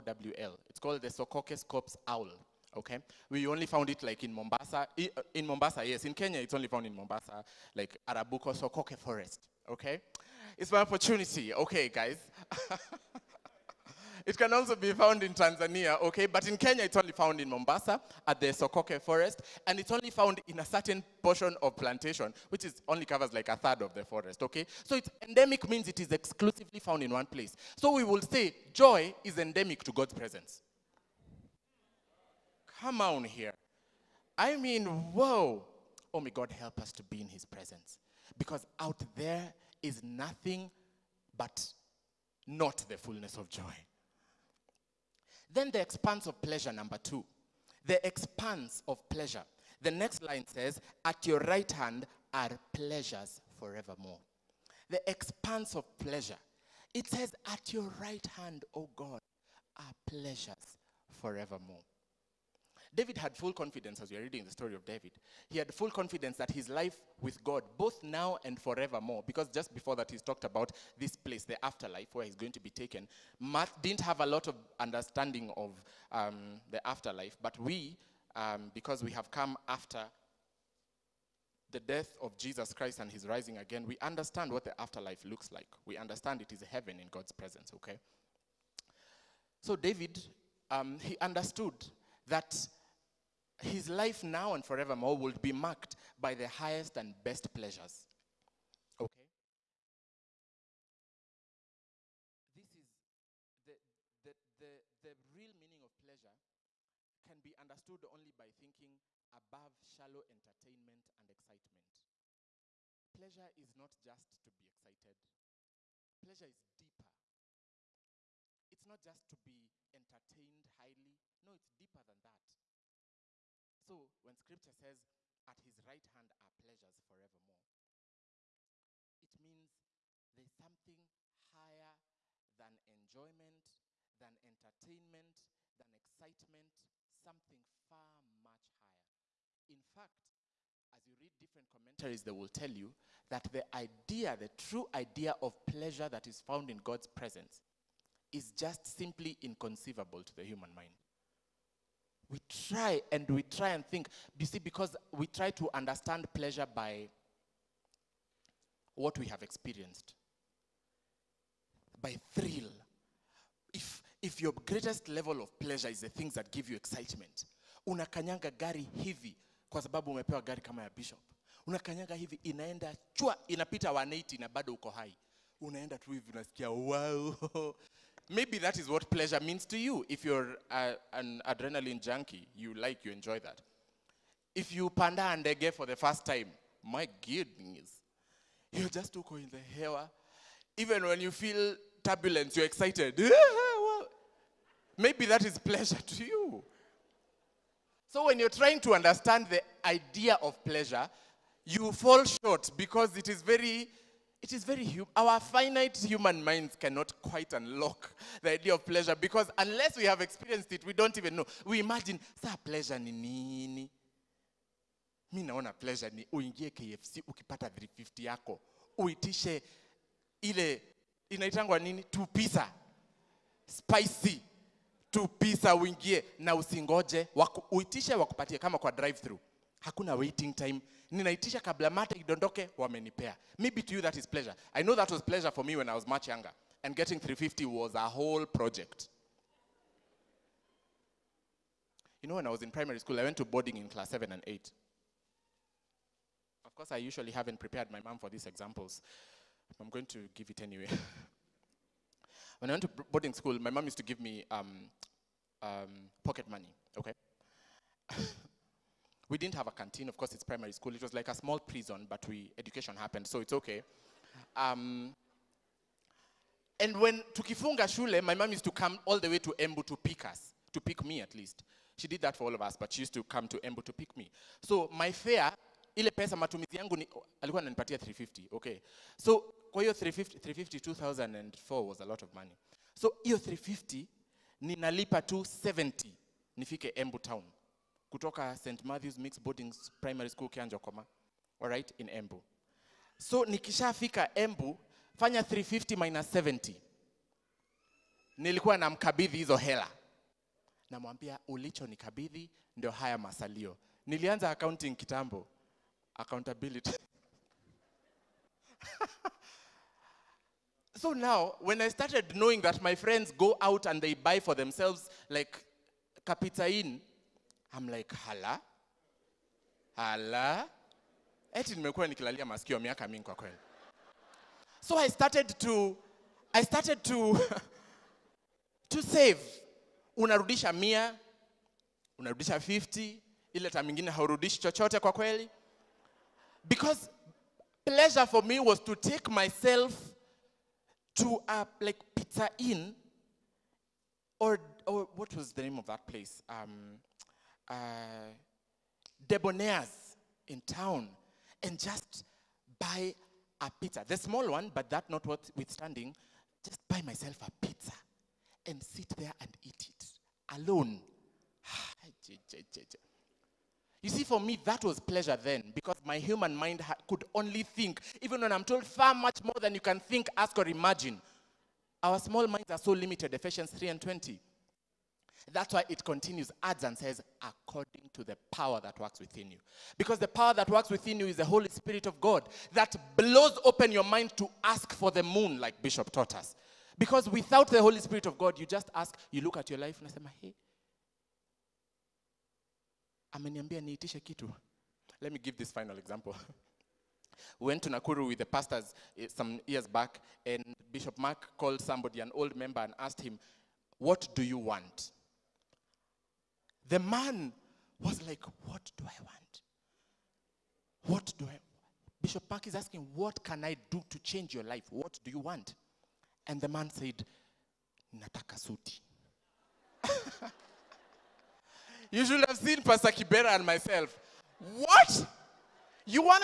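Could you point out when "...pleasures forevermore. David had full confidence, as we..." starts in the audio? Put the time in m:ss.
1:00.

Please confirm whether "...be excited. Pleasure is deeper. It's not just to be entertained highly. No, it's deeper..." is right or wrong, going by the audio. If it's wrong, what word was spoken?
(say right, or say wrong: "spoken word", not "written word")
right.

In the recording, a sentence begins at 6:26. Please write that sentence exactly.
Because without the Holy Spirit of God, you just ask, you look at your life, and unasema, hey, ameniambia niitishe kitu.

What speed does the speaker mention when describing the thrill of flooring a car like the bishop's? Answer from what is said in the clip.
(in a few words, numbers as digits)
180.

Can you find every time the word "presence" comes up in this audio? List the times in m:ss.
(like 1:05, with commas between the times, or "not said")
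0:30, 0:37, 1:27, 2:27.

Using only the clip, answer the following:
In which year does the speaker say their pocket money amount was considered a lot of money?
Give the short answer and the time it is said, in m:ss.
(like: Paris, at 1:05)
2004, at 4:40.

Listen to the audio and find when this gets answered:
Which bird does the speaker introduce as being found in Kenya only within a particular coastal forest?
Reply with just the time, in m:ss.
0:01.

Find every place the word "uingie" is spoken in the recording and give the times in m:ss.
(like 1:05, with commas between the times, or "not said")
3:36, 3:45.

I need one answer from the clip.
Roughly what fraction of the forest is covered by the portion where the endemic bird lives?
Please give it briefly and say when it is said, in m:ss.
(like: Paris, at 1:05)
a third, at 0:23.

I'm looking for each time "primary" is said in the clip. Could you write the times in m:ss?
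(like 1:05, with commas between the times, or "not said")
4:02, 4:20, 4:50.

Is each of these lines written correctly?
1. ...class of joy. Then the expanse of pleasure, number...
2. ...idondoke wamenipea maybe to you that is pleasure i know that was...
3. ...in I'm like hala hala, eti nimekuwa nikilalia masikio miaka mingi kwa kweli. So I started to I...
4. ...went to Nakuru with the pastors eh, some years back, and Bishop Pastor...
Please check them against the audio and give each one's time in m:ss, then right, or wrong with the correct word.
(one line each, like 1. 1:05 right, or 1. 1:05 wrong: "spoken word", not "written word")
1. 0:42 wrong: "fullness", not "class"
2. 3:52 right
3. 5:16 right
4. 6:37 wrong: "Mark", not "Pastor".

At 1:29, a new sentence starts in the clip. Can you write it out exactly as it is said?
So David, um, he understood that his life now and forevermore will be marked by the highest and best pleasures.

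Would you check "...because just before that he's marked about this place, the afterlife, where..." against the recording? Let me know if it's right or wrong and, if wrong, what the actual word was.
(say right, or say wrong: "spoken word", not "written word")
wrong: "talked", not "marked".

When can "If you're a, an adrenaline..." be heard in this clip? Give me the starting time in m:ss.
3:00.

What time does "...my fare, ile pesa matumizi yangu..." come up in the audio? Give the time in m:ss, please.
4:34.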